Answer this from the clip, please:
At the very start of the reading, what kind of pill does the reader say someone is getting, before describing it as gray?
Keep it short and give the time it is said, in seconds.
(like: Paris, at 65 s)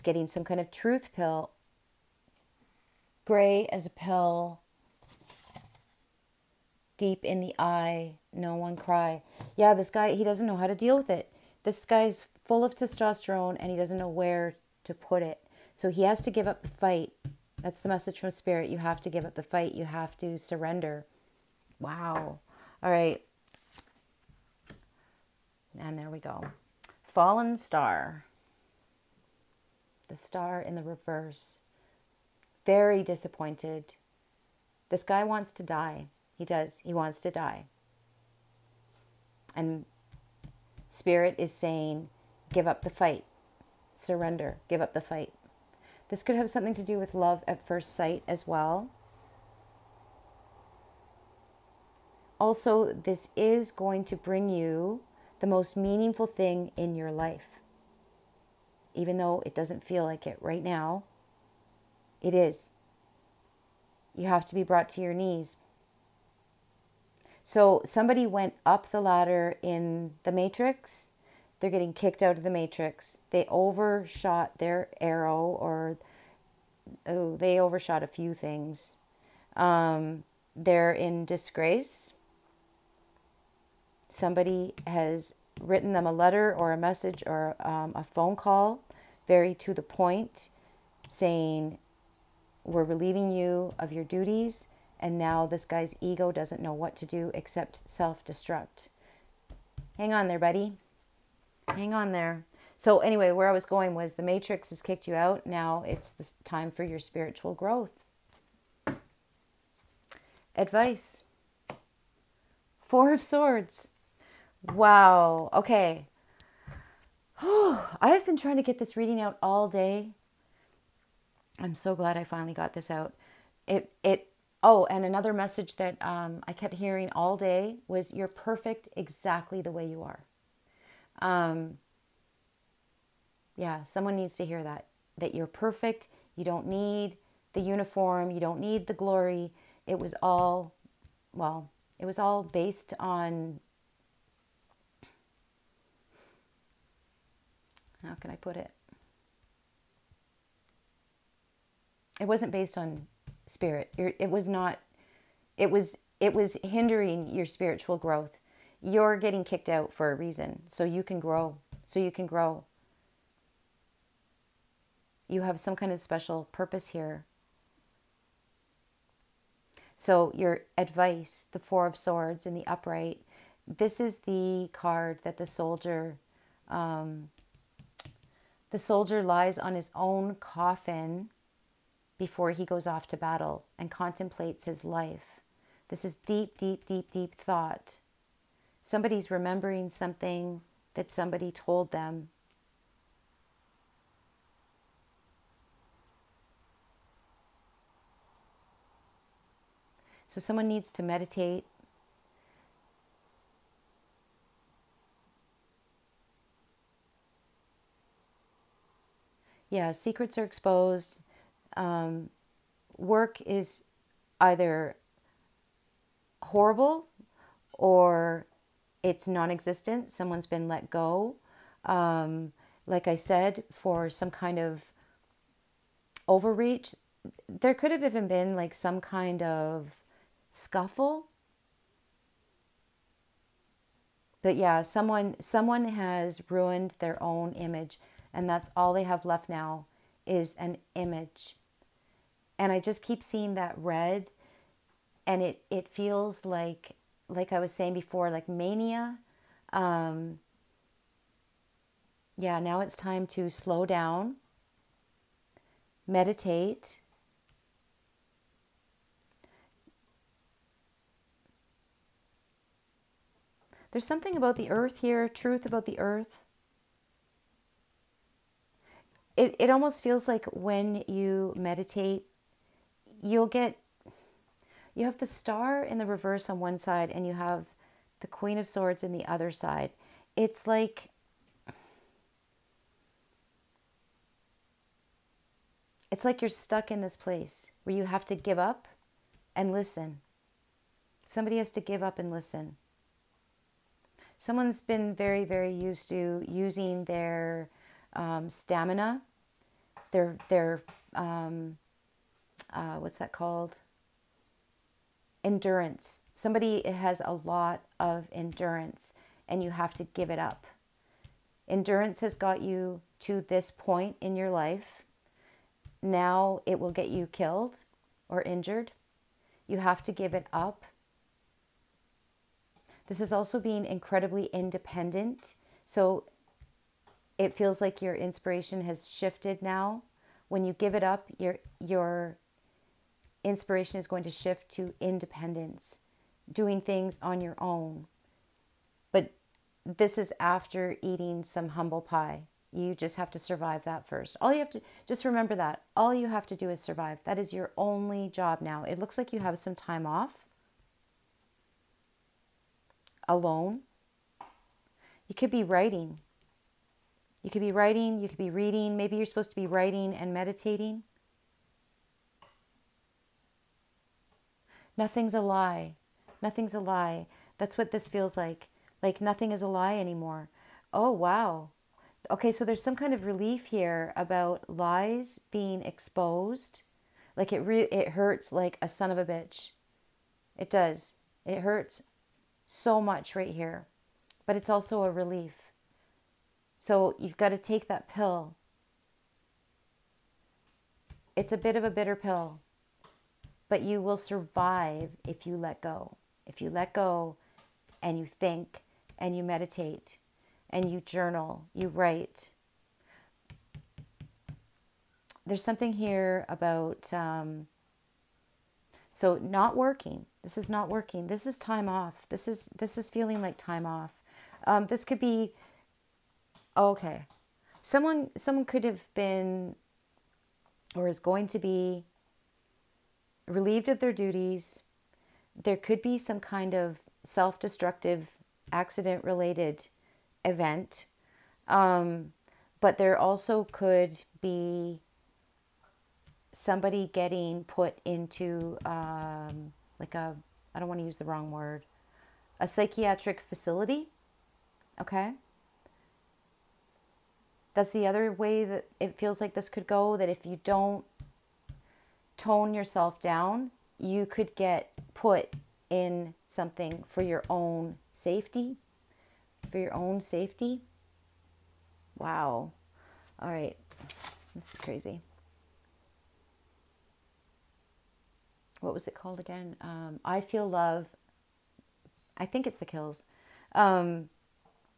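truth pill, at 0 s.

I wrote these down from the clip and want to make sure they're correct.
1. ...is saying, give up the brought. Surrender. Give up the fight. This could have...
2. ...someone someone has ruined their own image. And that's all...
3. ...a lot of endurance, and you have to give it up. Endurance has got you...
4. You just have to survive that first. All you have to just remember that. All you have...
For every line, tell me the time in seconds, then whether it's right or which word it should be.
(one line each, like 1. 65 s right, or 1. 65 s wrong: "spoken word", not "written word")
1. 41 s wrong: "fight", not "brought"
2. 234 s right
3. 307 s right
4. 342 s right.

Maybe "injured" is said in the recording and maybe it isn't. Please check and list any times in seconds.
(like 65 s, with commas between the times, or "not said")
318 s.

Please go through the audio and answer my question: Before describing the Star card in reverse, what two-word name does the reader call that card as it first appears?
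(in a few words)
Fallen star.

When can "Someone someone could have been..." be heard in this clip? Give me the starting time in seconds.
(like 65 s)
417 s.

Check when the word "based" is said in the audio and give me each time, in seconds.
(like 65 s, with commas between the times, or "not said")
142 s, 152 s.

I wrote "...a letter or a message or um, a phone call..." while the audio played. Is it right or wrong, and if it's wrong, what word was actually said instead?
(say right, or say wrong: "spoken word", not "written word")
right.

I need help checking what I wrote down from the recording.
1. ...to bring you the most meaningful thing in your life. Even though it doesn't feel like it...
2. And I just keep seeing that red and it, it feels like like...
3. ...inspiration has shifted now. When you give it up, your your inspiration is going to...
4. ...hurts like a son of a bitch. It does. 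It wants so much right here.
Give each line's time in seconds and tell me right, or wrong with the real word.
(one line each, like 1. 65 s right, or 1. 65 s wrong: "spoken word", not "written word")
1. 54 s right
2. 242 s right
3. 328 s right
4. 378 s wrong: "hurts", not "wants".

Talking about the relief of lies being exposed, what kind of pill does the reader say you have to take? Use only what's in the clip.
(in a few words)
a bitter pill.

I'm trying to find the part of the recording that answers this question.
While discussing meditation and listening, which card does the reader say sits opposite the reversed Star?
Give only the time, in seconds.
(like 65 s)
278 s.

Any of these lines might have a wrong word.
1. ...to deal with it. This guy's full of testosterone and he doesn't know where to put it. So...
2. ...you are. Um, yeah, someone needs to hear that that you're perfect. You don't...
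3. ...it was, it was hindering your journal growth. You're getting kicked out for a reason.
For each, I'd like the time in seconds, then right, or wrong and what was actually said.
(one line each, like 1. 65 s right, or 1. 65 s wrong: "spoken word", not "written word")
1. 10 s right
2. 129 s right
3. 155 s wrong: "spiritual", not "journal".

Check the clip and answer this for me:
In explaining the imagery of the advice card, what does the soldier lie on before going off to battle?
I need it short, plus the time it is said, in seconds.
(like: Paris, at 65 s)
his own coffin, at 179 s.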